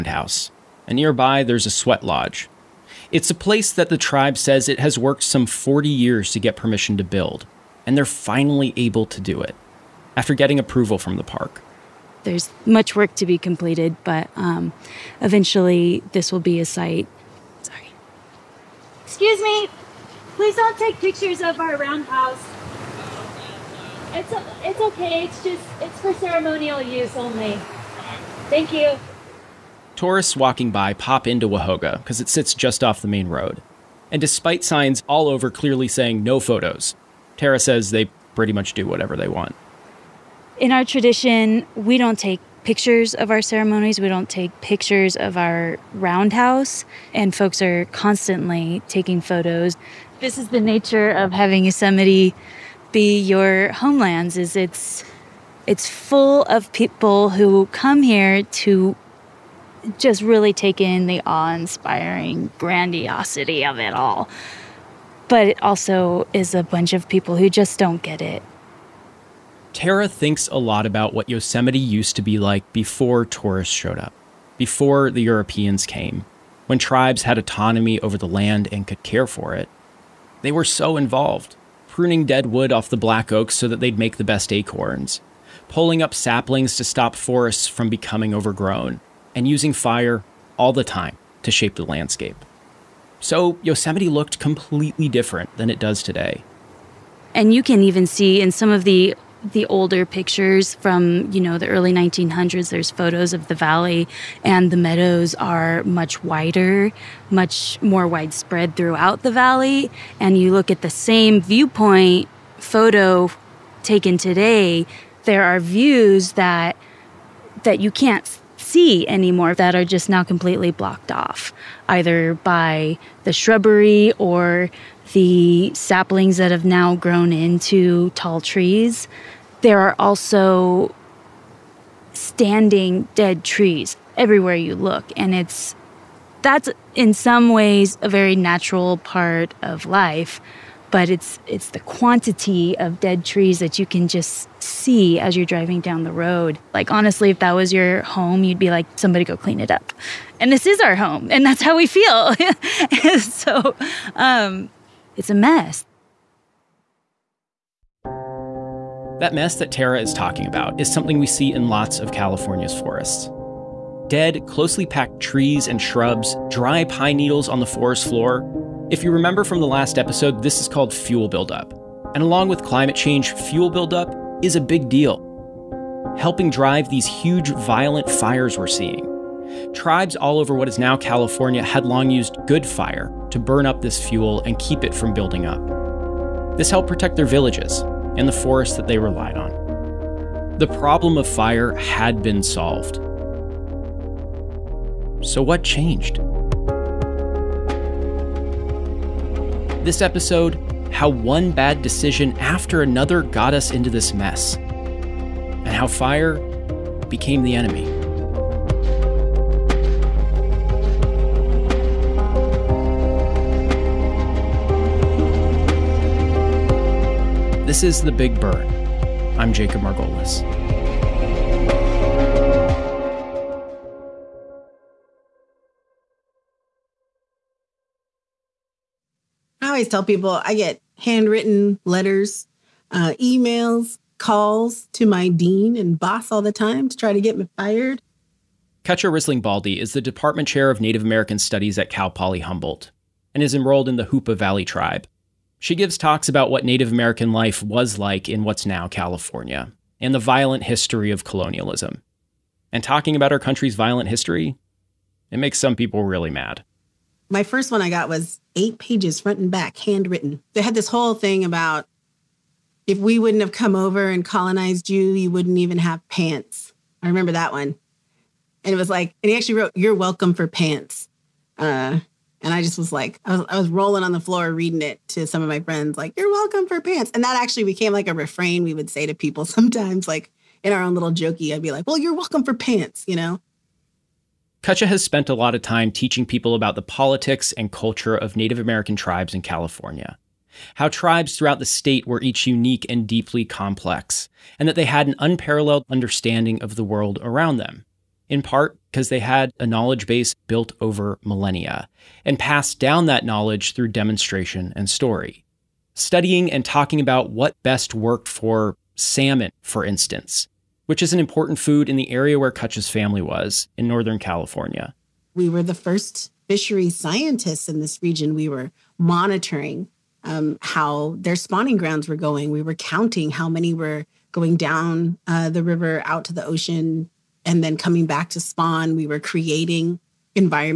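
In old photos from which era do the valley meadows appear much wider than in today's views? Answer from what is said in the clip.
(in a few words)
Early 1900s.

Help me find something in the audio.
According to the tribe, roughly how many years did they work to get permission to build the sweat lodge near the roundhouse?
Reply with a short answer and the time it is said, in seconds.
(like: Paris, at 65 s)
40 years, at 5 s.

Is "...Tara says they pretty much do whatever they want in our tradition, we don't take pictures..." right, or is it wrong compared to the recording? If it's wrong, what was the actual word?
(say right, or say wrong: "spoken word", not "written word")
right.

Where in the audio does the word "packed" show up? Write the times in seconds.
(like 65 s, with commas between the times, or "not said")
164 s.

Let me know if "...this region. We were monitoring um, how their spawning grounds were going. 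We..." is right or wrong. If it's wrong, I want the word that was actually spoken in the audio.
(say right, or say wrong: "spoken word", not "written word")
right.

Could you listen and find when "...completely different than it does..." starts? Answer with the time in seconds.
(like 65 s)
94 s.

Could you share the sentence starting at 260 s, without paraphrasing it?
They had this whole thing about if we wouldn't have come over and colonized you, you wouldn't even have pants.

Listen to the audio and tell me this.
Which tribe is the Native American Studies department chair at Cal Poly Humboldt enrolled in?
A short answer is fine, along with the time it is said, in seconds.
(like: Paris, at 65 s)
Hoopa Valley Tribe, at 244 s.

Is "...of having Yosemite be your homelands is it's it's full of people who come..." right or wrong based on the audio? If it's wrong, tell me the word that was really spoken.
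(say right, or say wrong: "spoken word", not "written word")
right.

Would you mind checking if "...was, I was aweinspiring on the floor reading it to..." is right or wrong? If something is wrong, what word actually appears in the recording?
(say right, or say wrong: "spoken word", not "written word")
wrong: "rolling", not "aweinspiring".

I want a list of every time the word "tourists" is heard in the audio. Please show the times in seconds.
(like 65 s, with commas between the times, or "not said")
29 s, 73 s.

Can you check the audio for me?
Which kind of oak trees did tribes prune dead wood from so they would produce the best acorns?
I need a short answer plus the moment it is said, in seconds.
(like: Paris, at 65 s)
Black oaks, at 82 s.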